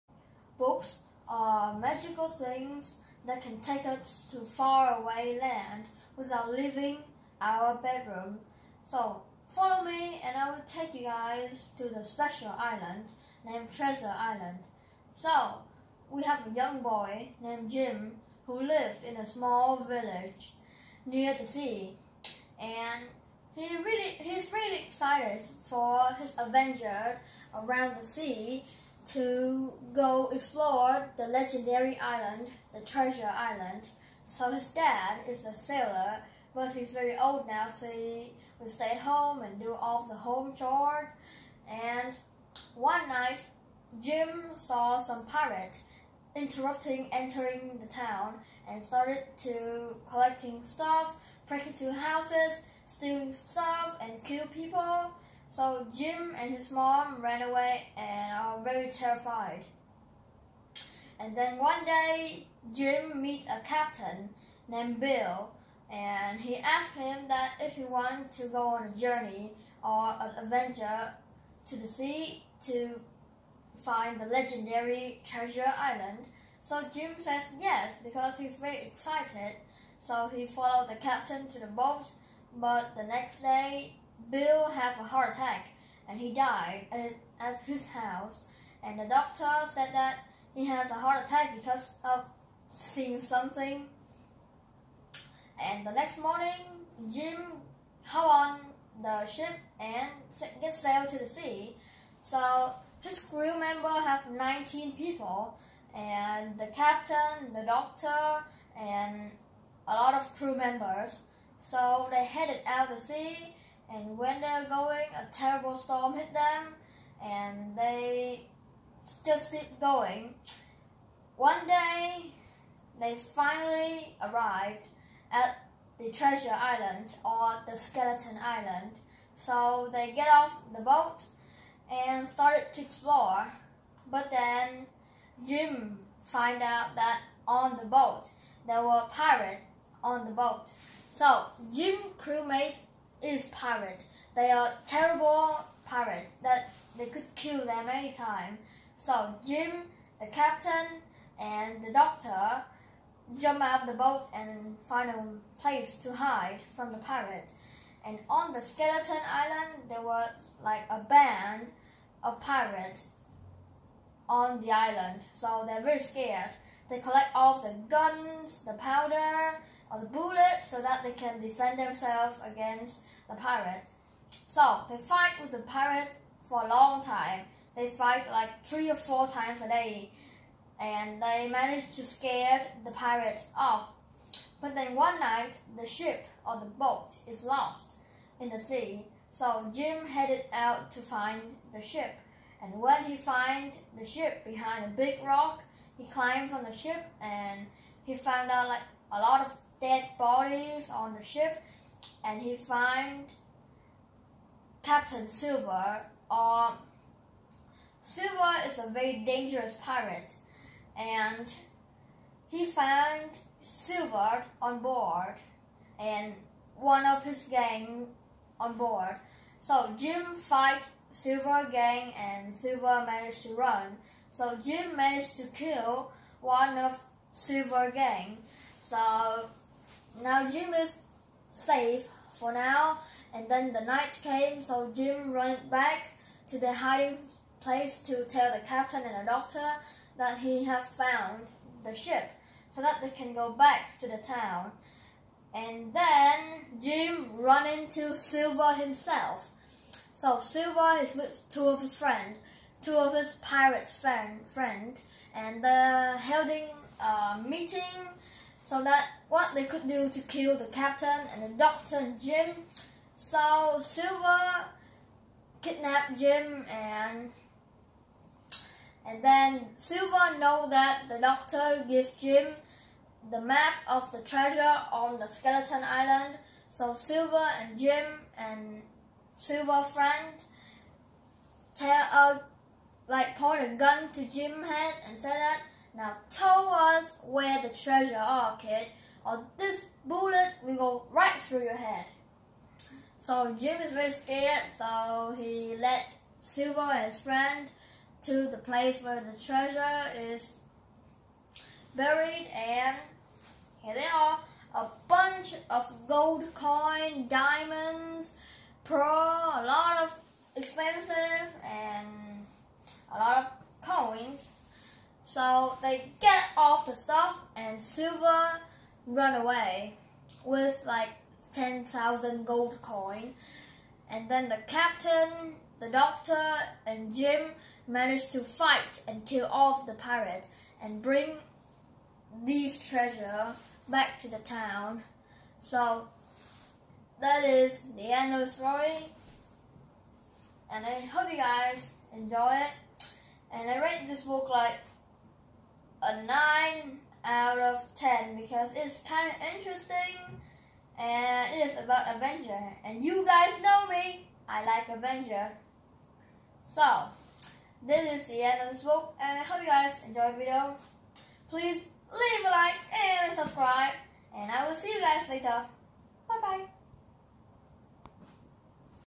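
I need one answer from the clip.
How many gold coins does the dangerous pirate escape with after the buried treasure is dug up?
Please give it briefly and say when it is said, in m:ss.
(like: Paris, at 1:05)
10,000, at 5:21.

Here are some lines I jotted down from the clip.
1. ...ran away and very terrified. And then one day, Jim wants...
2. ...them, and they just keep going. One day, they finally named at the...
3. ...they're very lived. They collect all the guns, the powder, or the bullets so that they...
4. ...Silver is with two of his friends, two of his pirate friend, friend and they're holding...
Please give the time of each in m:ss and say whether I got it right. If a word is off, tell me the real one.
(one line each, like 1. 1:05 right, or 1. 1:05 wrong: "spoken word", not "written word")
1. 0:57 wrong: "meets", not "wants"
2. 1:56 wrong: "arrived", not "named"
3. 2:45 wrong: "scared", not "lived"
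4. 4:10 right.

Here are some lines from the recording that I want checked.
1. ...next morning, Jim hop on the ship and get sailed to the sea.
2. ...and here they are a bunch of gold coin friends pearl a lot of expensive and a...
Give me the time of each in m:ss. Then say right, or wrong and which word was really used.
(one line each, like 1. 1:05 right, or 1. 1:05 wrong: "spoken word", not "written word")
1. 1:35 right
2. 5:02 wrong: "diamonds", not "friends".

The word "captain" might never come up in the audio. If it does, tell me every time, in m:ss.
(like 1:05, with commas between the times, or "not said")
1:03, 1:20, 1:46, 2:30, 3:24, 3:58, 4:20, 5:24.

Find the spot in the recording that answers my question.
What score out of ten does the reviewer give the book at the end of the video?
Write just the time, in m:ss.
5:46.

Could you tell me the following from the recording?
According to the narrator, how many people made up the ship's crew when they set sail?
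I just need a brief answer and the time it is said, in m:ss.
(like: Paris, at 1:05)
19, at 1:44.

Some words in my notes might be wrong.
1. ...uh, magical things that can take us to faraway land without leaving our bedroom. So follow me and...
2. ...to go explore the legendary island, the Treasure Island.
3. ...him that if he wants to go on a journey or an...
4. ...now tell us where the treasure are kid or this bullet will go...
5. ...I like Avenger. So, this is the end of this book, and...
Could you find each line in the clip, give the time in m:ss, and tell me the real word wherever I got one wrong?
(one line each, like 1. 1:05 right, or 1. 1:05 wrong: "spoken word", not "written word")
1. 0:01 right
2. 0:29 right
3. 1:06 right
4. 4:45 right
5. 5:54 right.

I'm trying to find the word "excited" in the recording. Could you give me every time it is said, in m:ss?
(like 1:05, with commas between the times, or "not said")
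0:24, 1:18.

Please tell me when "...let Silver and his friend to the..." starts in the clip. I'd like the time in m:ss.
4:55.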